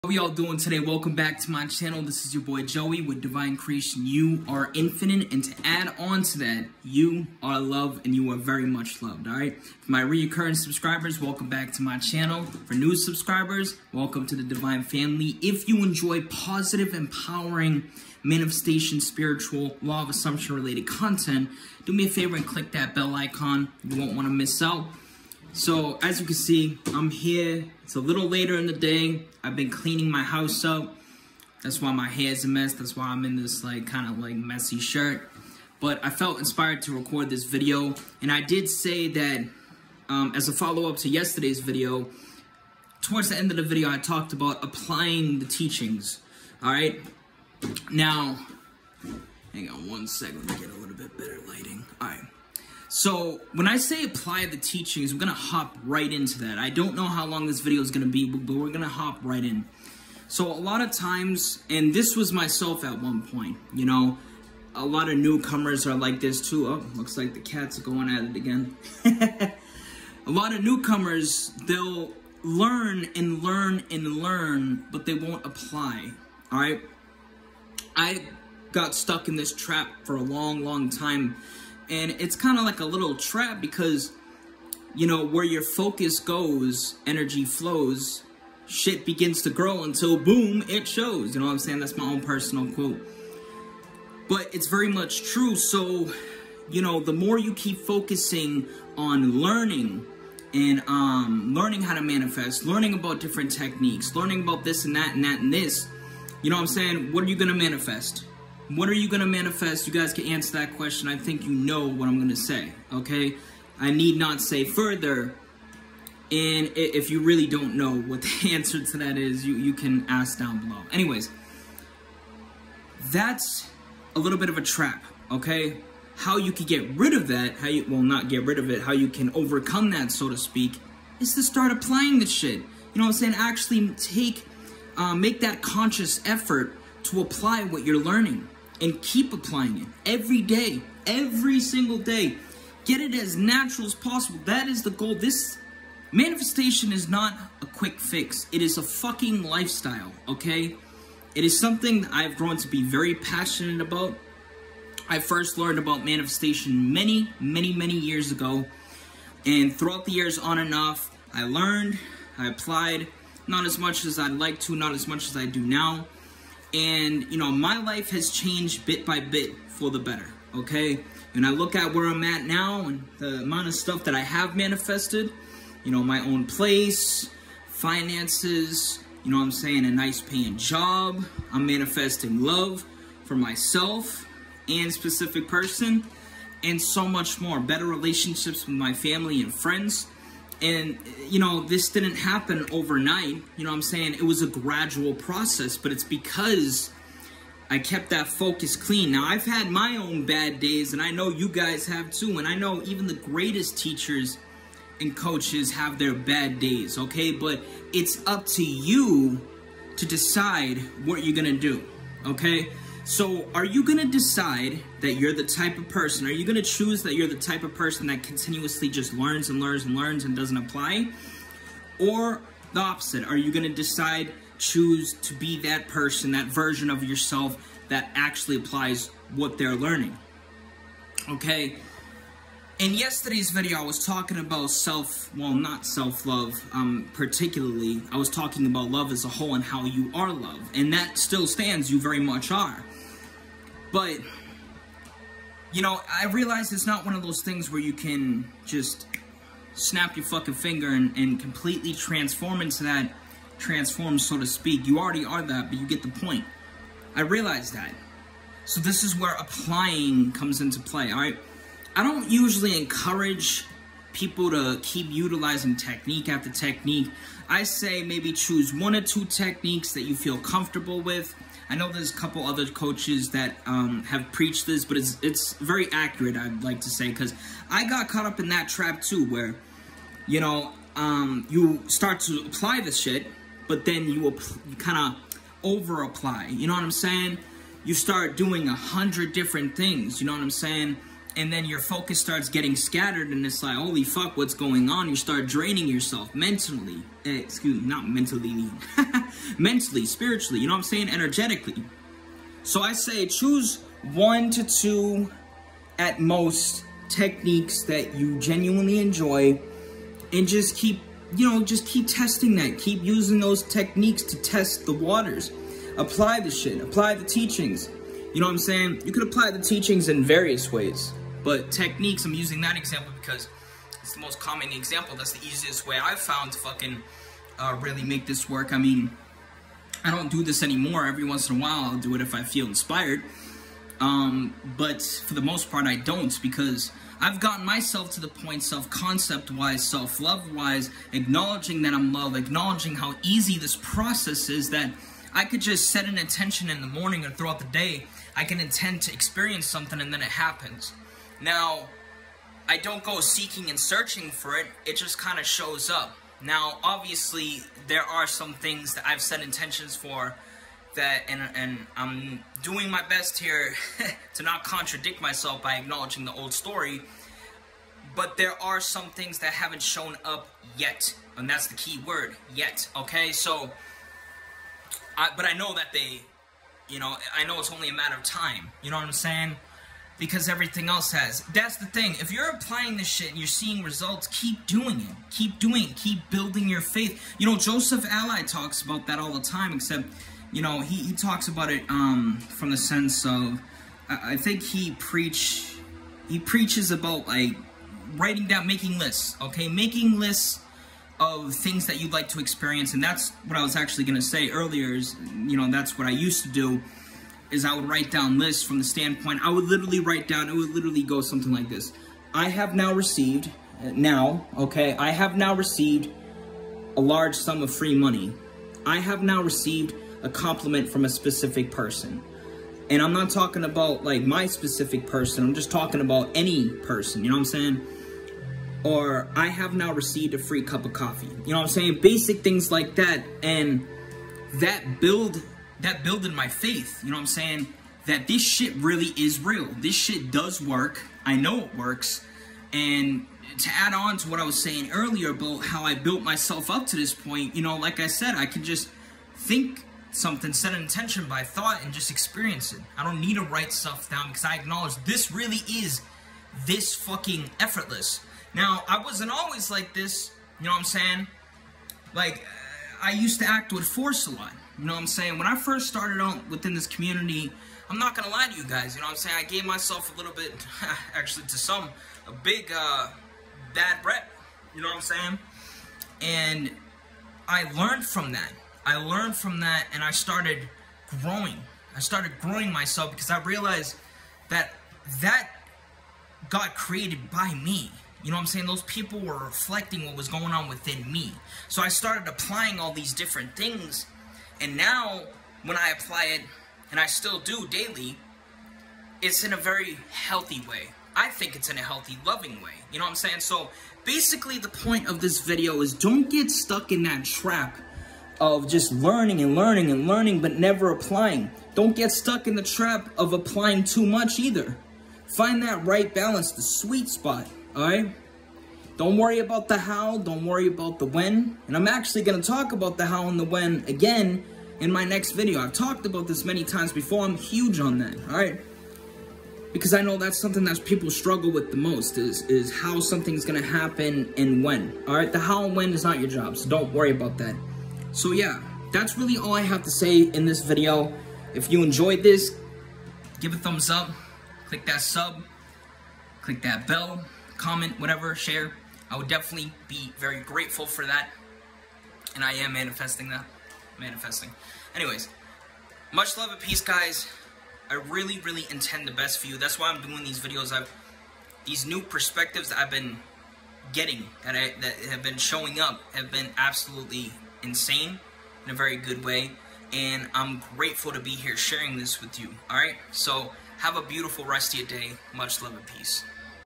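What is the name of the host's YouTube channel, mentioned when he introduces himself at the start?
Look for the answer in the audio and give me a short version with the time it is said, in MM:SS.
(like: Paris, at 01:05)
Divine Creation, at 00:03.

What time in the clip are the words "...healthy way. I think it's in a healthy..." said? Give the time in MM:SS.
08:20.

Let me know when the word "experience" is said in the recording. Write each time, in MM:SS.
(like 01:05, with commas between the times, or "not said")
05:49, 06:42, 07:32.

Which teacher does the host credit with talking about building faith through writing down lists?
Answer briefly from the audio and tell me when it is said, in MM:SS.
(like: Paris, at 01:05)
Joseph Alai, at 06:27.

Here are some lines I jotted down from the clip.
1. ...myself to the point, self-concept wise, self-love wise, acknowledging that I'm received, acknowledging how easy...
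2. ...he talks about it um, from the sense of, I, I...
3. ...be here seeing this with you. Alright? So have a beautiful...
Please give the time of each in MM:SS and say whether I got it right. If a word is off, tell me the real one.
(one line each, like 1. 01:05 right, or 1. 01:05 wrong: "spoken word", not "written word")
1. 05:37 wrong: "loved", not "received"
2. 06:30 right
3. 09:31 wrong: "sharing", not "seeing".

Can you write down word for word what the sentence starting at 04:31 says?
I know there's a couple other coaches that um, have preached this, but it's it's very accurate.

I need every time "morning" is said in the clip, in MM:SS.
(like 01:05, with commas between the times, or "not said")
05:46.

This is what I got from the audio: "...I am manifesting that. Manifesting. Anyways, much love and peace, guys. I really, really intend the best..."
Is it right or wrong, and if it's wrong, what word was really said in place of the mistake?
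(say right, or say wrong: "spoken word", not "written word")
right.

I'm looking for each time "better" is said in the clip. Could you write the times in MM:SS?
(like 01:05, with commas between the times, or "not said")
00:51, 02:49, 03:07.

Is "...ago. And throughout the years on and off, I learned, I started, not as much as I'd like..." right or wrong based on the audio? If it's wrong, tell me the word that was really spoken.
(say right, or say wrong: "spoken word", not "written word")
wrong: "applied", not "started".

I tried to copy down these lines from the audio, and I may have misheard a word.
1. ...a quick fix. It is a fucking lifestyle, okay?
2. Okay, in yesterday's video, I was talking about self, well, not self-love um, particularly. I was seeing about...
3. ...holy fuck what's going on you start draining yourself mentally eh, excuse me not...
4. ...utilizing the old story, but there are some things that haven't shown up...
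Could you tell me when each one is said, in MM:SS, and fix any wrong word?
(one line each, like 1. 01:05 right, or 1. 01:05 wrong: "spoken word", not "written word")
1. 02:27 right
2. 03:51 wrong: "talking", not "seeing"
3. 04:53 right
4. 06:05 wrong: "acknowledging", not "utilizing".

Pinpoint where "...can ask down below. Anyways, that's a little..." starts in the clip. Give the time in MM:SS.
01:59.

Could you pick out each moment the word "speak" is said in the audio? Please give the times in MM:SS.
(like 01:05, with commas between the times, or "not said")
02:10, 04:14.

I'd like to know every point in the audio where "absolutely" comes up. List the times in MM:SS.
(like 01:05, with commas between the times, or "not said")
09:26.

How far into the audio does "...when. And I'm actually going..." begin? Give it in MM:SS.
08:41.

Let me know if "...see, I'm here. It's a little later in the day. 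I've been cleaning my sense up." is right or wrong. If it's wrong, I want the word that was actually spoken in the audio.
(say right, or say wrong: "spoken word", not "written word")
wrong: "house", not "sense".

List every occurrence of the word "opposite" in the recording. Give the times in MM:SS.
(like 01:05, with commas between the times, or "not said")
03:42.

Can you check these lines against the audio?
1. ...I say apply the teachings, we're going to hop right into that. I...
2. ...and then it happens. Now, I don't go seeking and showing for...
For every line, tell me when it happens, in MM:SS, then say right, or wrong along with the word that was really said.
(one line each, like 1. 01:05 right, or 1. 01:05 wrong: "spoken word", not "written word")
1. 00:53 right
2. 05:50 wrong: "searching", not "showing".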